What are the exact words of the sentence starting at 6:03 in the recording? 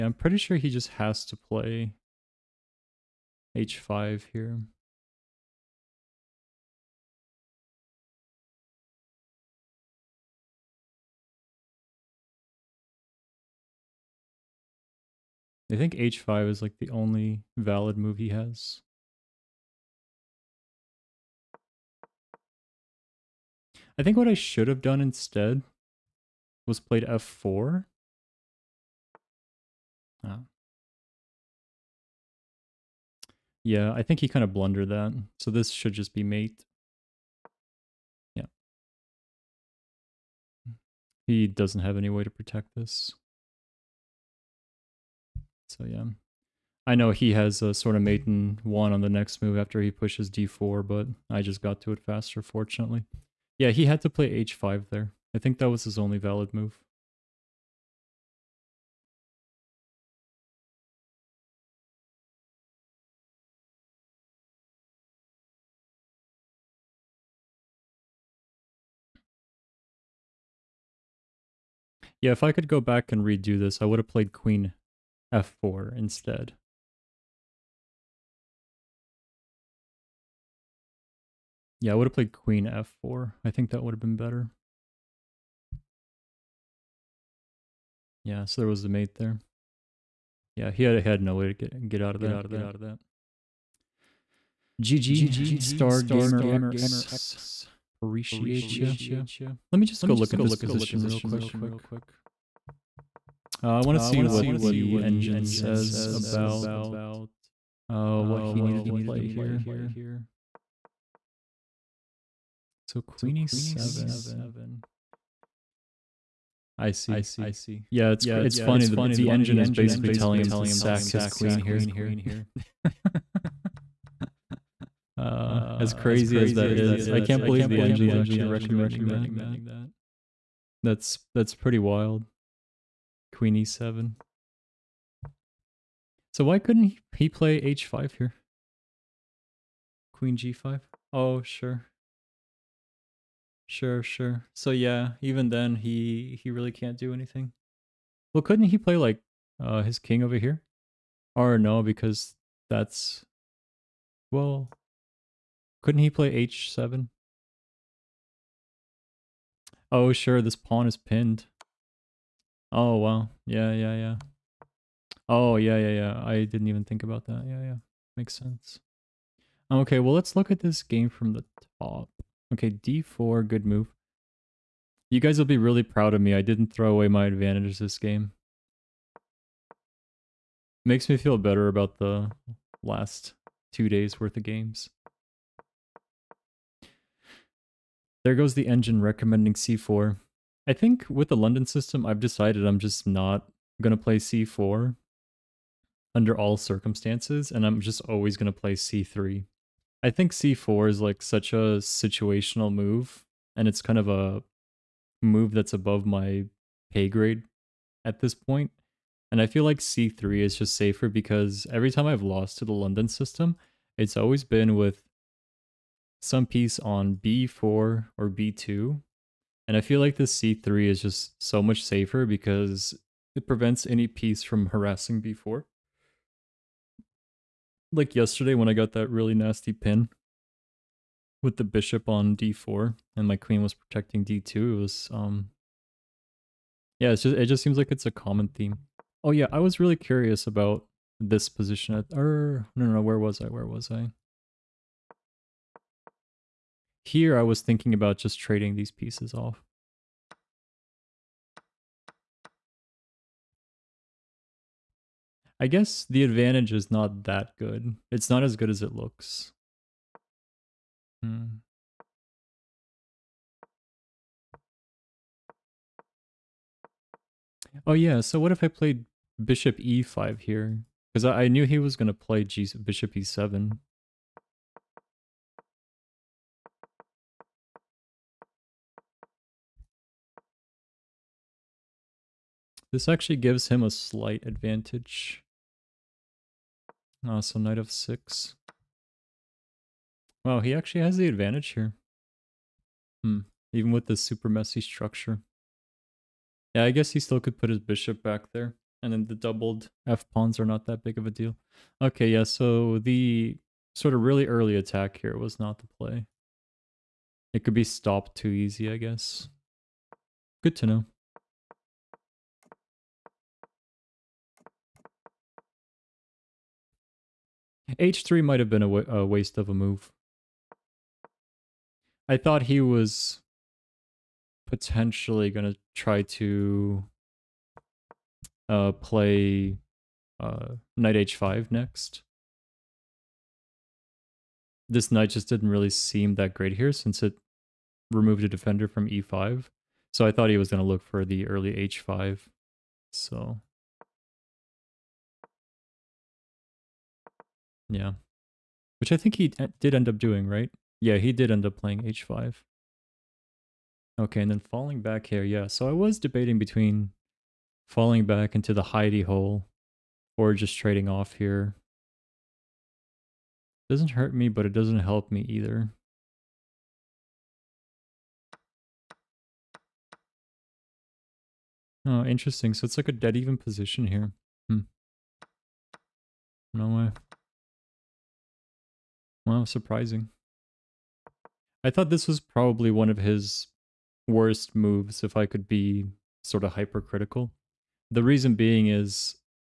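Doesn't hurt me, but it doesn't help me either.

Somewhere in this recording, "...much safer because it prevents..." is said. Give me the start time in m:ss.
3:41.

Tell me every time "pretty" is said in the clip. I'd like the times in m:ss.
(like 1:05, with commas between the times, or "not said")
0:00, 2:11.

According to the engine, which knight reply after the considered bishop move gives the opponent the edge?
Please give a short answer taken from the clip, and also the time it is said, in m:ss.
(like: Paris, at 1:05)
Knight f6, at 4:47.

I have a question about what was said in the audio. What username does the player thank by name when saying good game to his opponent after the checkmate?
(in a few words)
Star Gamer X.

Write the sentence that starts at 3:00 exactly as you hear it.
Makes me feel better about the last two days worth of games.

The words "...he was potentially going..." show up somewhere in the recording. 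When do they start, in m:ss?
5:22.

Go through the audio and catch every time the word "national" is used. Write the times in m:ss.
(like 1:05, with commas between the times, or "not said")
not said.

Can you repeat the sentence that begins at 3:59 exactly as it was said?
Oh yeah, I was really curious about this position at, or no, no, no, where was I?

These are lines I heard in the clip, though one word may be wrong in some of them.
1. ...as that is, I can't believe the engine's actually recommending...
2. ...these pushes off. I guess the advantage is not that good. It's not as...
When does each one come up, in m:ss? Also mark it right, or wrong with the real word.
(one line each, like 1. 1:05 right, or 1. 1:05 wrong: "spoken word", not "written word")
1. 2:06 right
2. 4:08 wrong: "pieces", not "pushes".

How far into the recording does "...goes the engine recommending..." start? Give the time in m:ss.
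3:08.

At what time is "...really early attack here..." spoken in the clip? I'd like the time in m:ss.
5:04.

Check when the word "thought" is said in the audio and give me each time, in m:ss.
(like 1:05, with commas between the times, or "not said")
5:22, 5:40, 6:21.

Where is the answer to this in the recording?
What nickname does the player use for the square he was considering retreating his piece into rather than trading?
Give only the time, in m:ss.
5:58.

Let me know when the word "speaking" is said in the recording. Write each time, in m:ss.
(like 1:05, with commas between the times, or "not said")
not said.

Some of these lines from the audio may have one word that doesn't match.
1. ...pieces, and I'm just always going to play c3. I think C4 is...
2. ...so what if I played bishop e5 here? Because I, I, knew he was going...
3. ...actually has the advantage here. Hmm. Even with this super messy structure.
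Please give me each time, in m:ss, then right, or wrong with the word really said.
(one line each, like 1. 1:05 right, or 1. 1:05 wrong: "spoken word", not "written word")
1. 3:16 wrong: "circumstances", not "pieces"
2. 4:28 right
3. 4:50 right.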